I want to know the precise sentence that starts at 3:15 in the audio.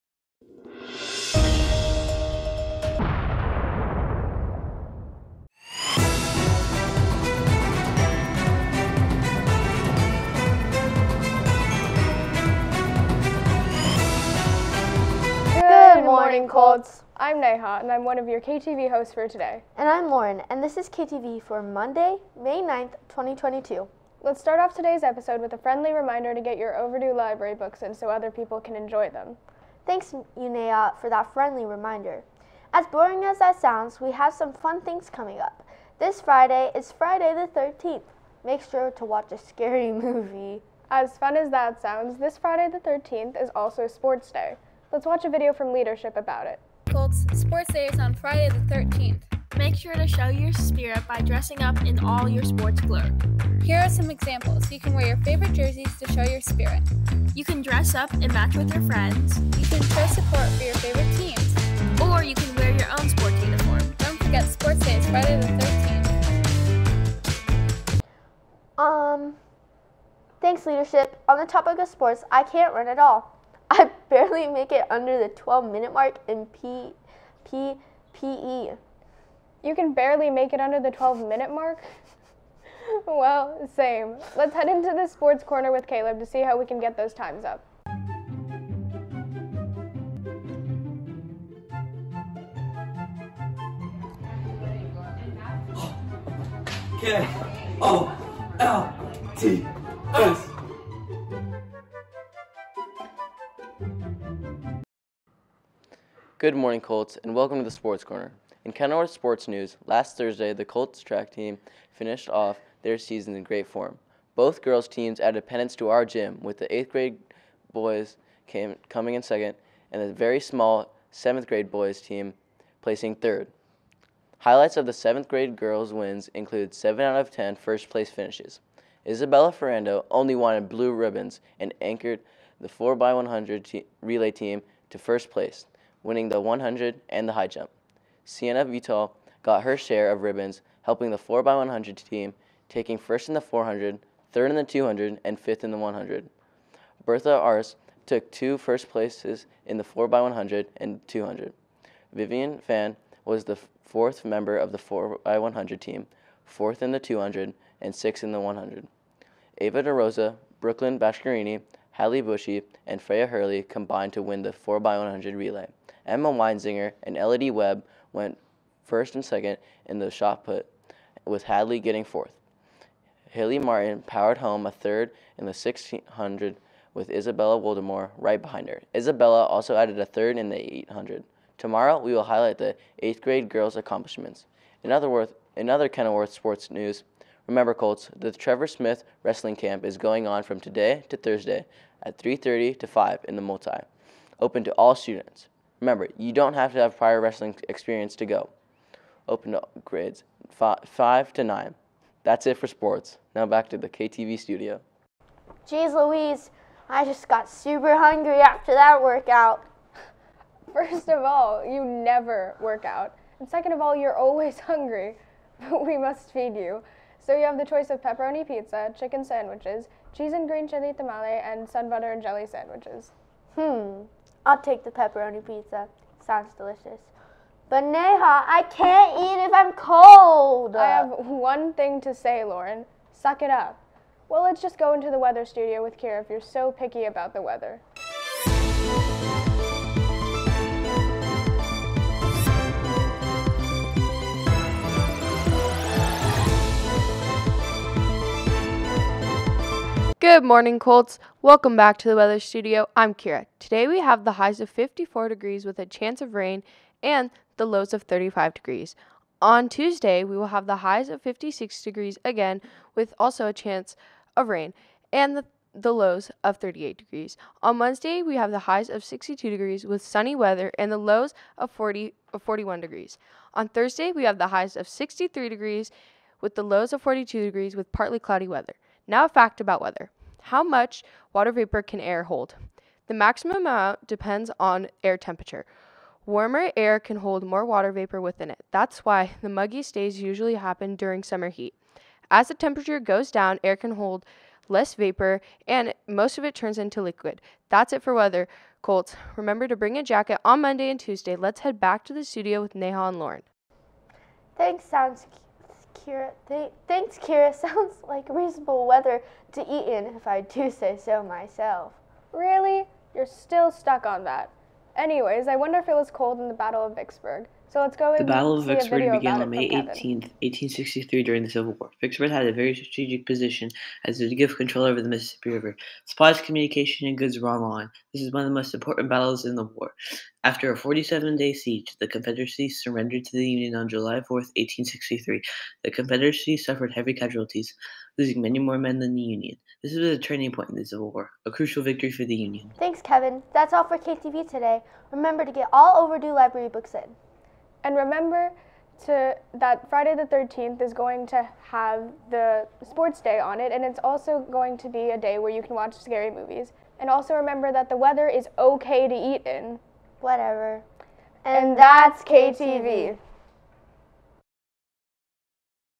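Remember, you don't have to have prior wrestling experience to go.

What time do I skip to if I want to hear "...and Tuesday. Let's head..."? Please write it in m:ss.
5:00.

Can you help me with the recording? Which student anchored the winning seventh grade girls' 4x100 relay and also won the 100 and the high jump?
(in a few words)
Isabella Ferrando.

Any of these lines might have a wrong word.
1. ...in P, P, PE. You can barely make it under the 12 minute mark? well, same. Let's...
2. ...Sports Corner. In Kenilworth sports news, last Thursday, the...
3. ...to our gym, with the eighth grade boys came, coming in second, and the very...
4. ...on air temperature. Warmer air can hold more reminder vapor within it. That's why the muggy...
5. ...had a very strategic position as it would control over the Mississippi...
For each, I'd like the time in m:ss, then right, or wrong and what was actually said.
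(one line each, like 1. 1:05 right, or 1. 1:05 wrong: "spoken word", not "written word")
1. 1:16 right
2. 1:47 right
3. 1:55 right
4. 4:44 wrong: "water", not "reminder"
5. 5:22 right.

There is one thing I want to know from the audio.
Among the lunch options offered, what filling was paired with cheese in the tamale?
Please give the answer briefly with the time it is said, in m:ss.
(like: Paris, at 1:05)
green chili, at 3:40.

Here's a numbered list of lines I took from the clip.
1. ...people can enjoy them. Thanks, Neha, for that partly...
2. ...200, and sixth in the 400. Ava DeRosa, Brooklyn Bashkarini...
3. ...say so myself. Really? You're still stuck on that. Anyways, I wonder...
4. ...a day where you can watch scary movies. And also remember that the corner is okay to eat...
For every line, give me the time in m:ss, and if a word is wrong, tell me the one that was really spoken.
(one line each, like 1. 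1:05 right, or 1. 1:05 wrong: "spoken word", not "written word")
1. 0:28 wrong: "friendly", not "partly"
2. 2:36 wrong: "100", not "400"
3. 5:10 right
4. 5:55 wrong: "weather", not "corner".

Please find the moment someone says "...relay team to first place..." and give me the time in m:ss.
2:14.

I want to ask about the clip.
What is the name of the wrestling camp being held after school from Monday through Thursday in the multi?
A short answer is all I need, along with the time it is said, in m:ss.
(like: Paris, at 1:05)
Trevor Smith Wrestling Camp, at 3:08.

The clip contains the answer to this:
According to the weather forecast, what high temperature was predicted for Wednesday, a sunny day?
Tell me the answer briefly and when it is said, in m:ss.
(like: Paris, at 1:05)
62 degrees, at 4:29.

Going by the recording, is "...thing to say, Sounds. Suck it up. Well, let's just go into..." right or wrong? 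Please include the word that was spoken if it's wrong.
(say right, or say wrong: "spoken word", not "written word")
wrong: "Lauren", not "Sounds".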